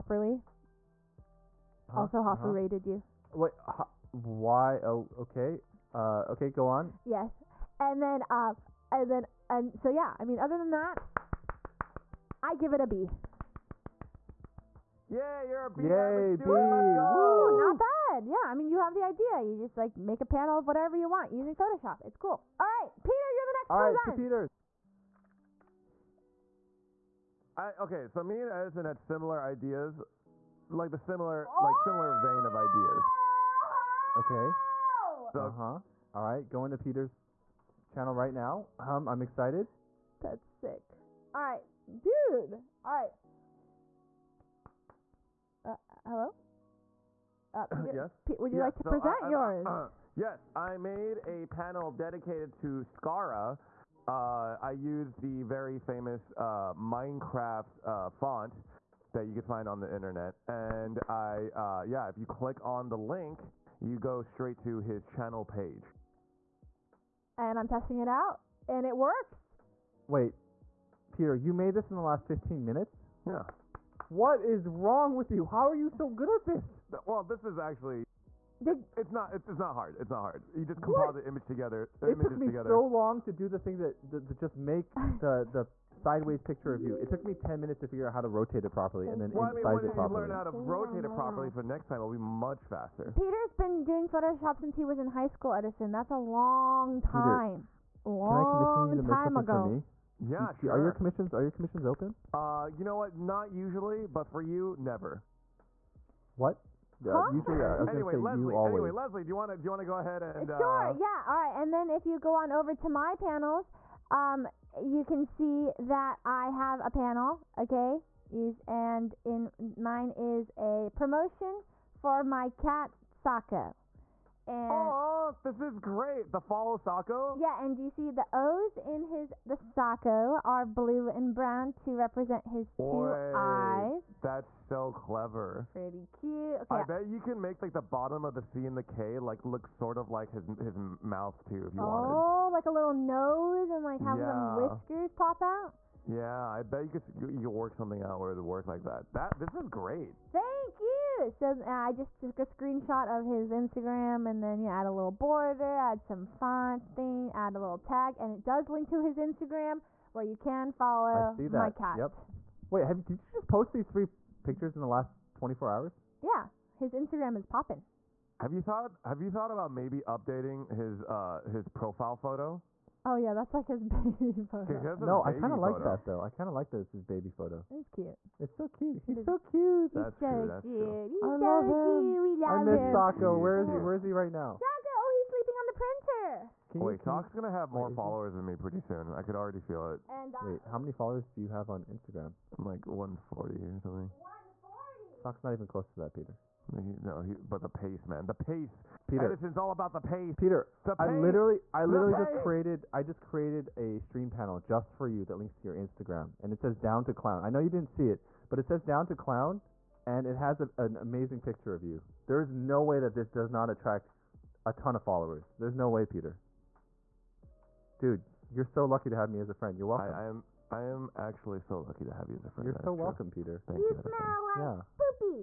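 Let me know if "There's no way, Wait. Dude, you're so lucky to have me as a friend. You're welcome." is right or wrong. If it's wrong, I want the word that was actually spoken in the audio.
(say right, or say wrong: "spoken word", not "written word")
wrong: "Peter", not "Wait".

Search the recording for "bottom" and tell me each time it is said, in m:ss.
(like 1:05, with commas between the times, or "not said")
2:17.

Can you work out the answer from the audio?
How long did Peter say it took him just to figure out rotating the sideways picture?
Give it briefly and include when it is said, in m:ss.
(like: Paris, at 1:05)
10 minutes, at 1:27.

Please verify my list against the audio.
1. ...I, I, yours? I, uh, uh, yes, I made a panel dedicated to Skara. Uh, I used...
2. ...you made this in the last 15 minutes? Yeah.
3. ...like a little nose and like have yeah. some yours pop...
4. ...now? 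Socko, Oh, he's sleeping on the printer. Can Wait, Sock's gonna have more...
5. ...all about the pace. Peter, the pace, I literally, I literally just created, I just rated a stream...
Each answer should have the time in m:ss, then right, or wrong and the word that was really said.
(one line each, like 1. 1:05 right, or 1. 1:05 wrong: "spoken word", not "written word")
1. 0:49 right
2. 1:11 right
3. 2:22 wrong: "whiskers", not "yours"
4. 3:04 right
5. 3:19 wrong: "created", not "rated".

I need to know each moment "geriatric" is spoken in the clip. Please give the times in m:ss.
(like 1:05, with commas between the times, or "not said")
not said.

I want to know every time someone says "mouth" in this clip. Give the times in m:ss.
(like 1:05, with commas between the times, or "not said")
2:21.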